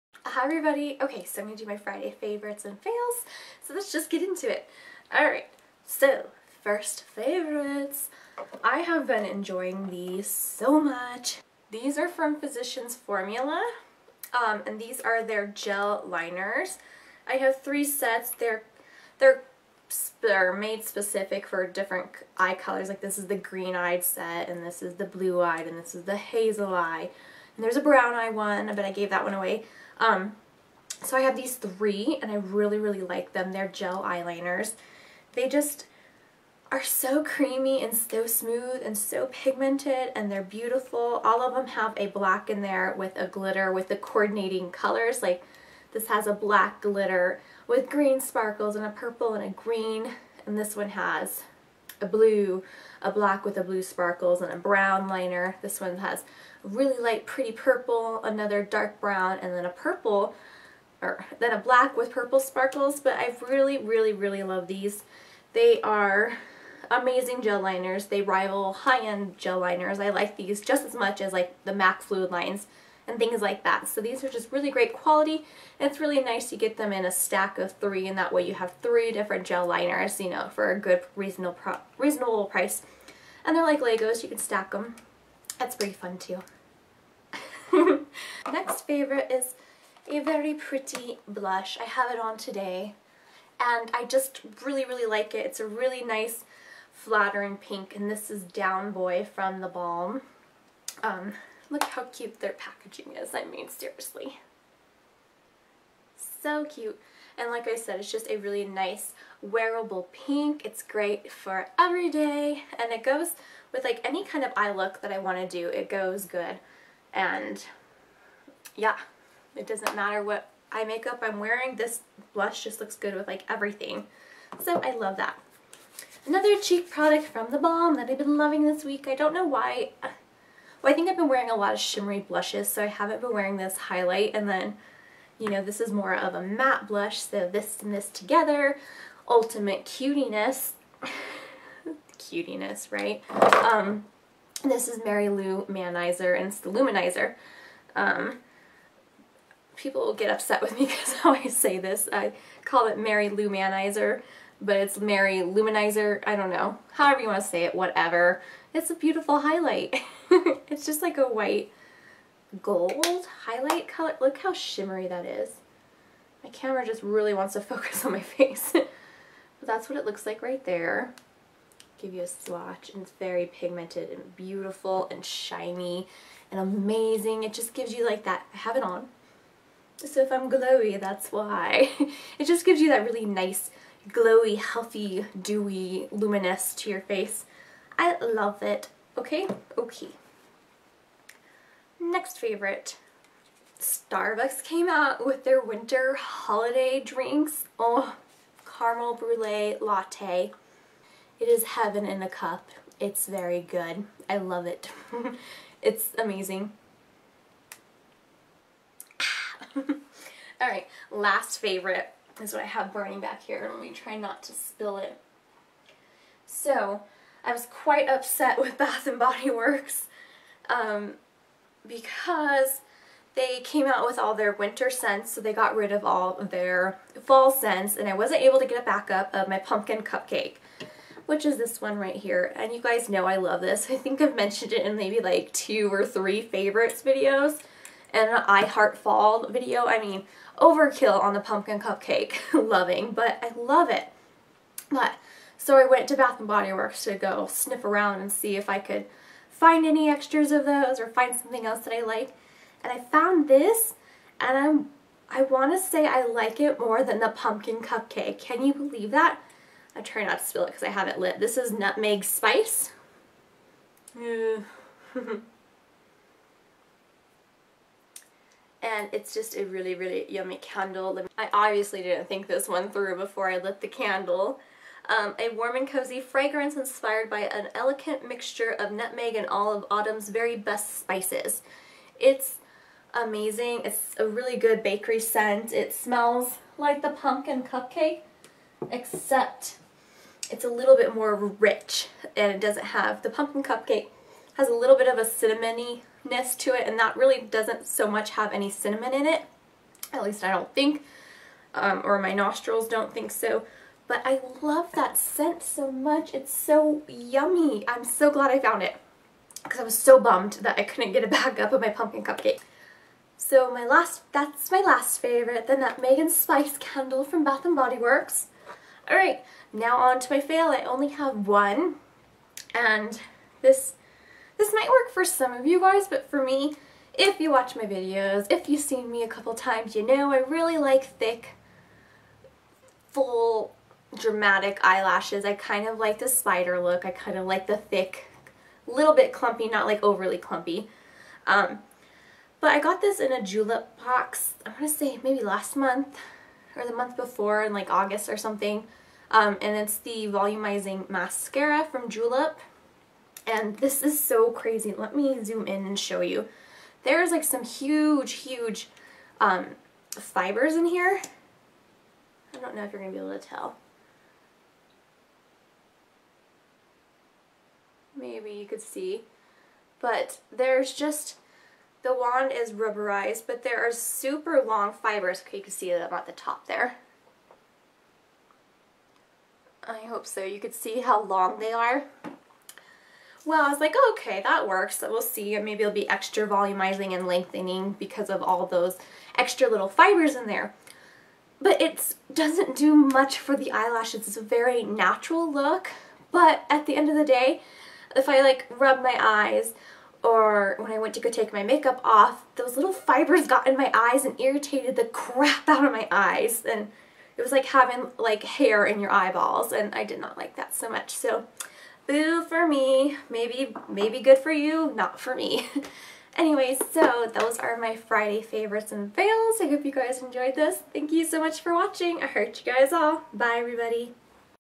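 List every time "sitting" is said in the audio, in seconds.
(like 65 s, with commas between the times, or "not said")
not said.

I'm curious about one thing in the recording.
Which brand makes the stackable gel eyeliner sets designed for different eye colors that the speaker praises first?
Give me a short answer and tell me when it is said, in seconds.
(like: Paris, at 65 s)
Physicians Formula, at 12 s.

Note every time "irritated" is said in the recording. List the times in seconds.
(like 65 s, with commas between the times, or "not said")
404 s.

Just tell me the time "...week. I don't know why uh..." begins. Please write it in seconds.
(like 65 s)
128 s.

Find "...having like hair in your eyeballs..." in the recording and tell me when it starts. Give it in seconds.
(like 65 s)
407 s.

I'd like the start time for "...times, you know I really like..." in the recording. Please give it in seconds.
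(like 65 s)
329 s.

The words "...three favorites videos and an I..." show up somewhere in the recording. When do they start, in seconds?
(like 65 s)
236 s.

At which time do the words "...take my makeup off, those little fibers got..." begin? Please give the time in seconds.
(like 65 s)
401 s.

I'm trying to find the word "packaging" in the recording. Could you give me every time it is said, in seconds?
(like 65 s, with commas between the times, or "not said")
102 s.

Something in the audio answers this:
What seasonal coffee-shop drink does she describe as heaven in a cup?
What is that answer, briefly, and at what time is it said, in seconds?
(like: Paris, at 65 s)
Caramel brulee latte, at 198 s.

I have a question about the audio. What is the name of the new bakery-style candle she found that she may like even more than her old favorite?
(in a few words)
Nutmeg spice.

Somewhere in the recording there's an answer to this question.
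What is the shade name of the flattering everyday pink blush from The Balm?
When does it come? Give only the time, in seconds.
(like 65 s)
98 s.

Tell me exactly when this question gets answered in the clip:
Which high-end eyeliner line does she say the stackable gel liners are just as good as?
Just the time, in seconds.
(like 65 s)
71 s.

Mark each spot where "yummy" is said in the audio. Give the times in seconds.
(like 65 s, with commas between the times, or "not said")
270 s, 307 s.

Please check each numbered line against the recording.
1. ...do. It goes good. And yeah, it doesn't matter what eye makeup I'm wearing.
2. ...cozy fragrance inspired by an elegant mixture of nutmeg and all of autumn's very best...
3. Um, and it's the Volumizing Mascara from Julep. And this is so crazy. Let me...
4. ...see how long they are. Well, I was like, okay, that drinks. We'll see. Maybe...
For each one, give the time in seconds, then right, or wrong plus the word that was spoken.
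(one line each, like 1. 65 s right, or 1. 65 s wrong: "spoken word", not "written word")
1. 115 s right
2. 275 s right
3. 349 s right
4. 380 s wrong: "works", not "drinks".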